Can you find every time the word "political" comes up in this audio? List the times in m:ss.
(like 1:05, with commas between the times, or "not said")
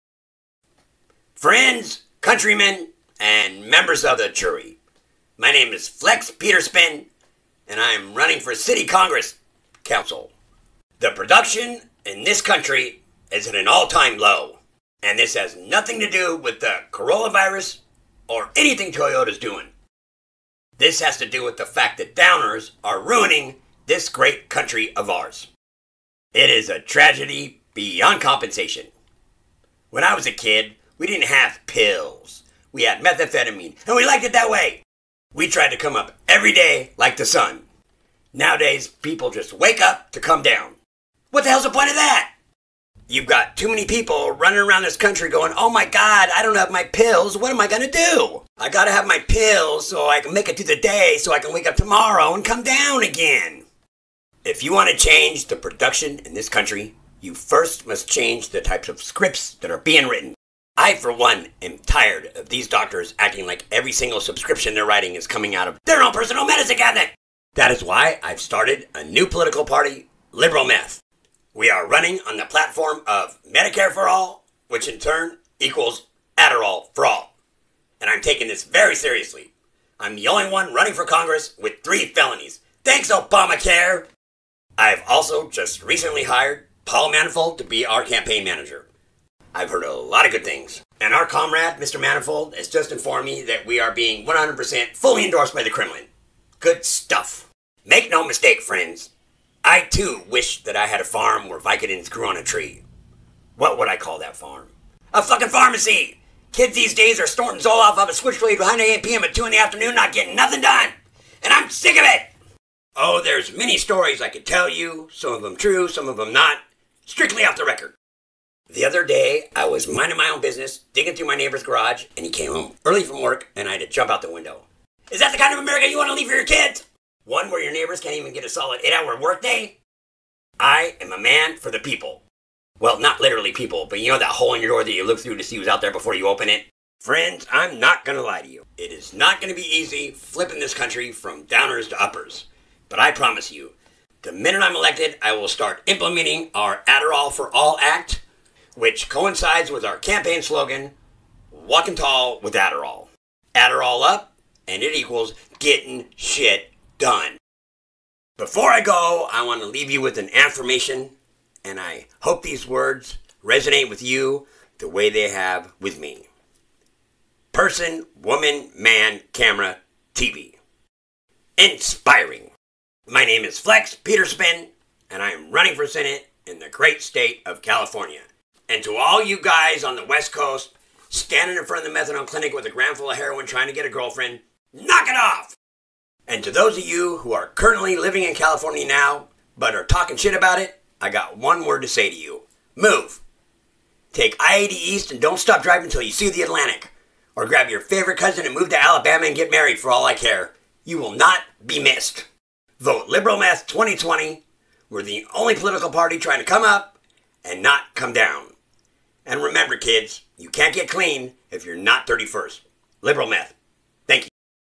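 1:09, 3:25.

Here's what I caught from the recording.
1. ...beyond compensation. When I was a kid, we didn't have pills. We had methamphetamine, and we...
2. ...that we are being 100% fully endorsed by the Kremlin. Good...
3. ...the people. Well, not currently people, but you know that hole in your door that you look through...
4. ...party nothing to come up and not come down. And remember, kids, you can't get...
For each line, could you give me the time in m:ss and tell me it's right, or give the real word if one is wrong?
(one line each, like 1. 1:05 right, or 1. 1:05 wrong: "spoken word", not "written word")
1. 0:27 right
2. 1:33 right
3. 2:11 wrong: "literally", not "currently"
4. 3:25 wrong: "trying", not "nothing".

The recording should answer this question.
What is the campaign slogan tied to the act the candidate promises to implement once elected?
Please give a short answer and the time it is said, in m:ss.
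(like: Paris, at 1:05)
Walking Tall with Adderall, at 2:31.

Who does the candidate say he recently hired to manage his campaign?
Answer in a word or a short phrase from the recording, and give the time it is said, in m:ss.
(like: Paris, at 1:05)
Paul Manifold, at 1:26.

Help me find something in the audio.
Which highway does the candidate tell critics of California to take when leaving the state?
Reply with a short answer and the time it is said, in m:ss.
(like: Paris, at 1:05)
I-80 East, at 3:14.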